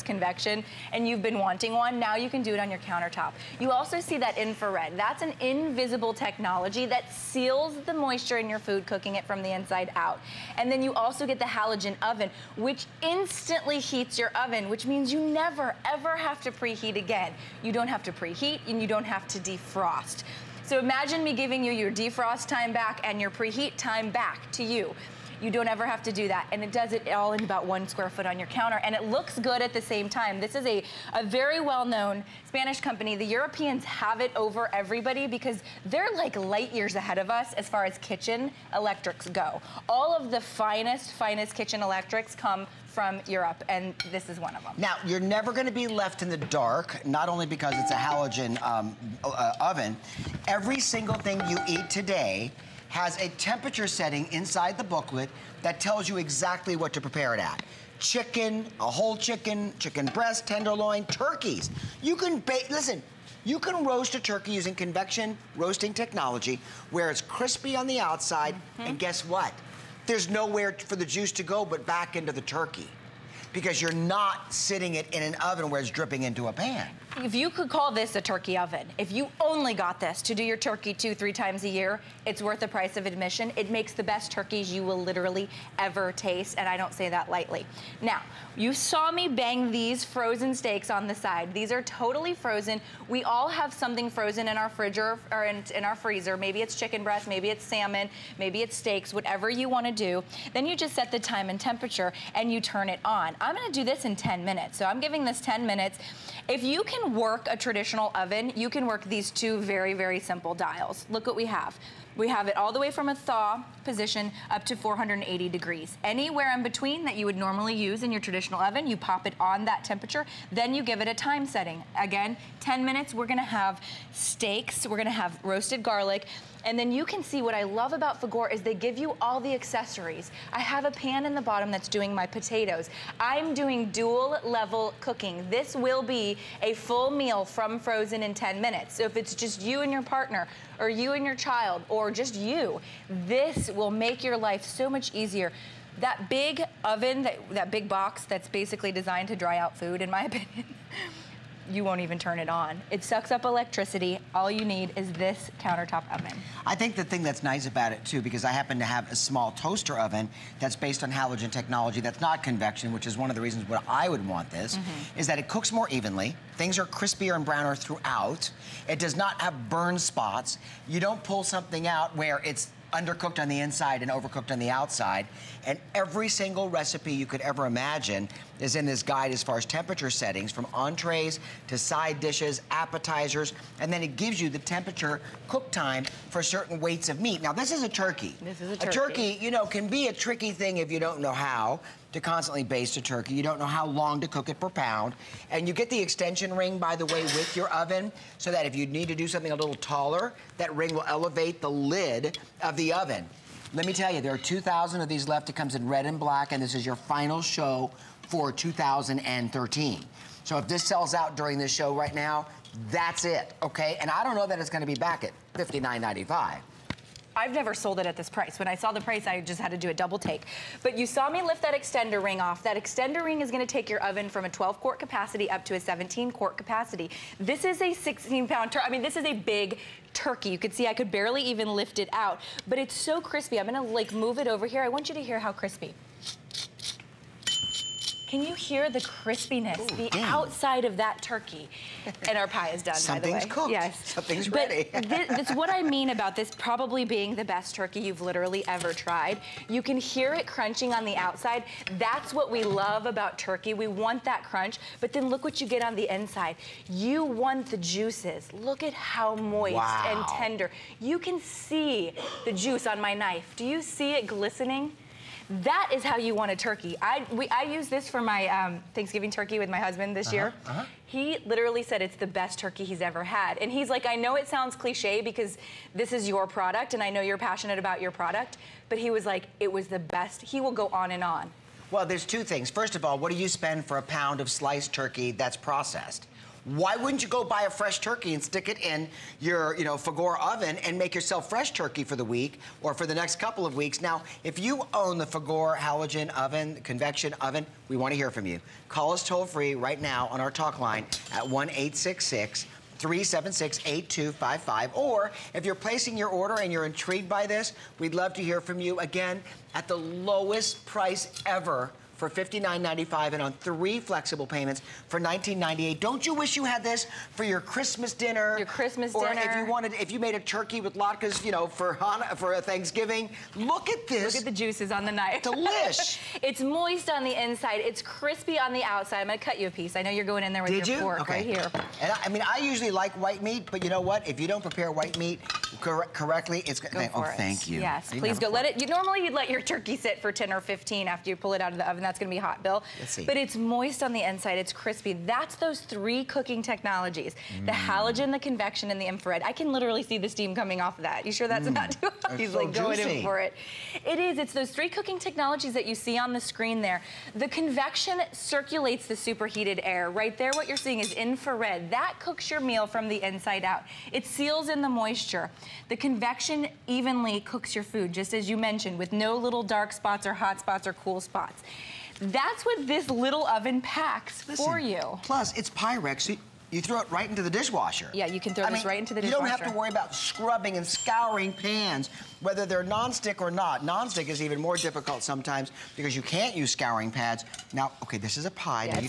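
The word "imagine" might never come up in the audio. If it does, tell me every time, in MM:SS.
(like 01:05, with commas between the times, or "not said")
00:20, 02:57.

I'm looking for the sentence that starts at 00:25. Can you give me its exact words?
You don't ever have to do that.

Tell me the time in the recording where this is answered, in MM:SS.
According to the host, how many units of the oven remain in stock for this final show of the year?
03:24.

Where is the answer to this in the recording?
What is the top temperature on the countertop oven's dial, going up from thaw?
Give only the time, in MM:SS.
01:54.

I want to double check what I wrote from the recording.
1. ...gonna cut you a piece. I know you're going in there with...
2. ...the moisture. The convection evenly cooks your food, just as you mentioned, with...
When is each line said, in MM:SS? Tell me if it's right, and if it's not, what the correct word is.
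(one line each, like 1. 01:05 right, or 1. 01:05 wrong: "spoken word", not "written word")
1. 05:29 right
2. 06:04 right.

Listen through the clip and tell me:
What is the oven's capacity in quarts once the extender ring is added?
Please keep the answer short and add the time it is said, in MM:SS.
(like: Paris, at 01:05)
17 quart, at 03:45.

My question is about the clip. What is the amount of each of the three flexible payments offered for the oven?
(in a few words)
$19.98.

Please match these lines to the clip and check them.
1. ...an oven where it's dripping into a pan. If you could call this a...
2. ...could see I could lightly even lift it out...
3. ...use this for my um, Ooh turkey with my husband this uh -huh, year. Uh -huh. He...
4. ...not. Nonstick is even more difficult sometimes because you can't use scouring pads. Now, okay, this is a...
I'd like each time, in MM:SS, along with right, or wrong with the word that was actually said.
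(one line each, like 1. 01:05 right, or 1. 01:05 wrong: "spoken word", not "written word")
1. 01:15 right
2. 03:50 wrong: "barely", not "lightly"
3. 04:27 wrong: "Thanksgiving", not "Ooh"
4. 06:23 right.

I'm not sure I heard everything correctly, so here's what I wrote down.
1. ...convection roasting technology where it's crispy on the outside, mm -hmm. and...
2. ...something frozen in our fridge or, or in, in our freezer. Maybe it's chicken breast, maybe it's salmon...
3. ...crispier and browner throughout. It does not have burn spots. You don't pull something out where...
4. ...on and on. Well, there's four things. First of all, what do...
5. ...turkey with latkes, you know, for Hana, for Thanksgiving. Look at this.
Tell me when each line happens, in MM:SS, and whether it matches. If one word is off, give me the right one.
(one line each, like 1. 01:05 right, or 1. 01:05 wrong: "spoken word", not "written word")
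1. 01:04 right
2. 01:33 right
3. 02:46 right
4. 04:40 wrong: "two", not "four"
5. 05:20 right.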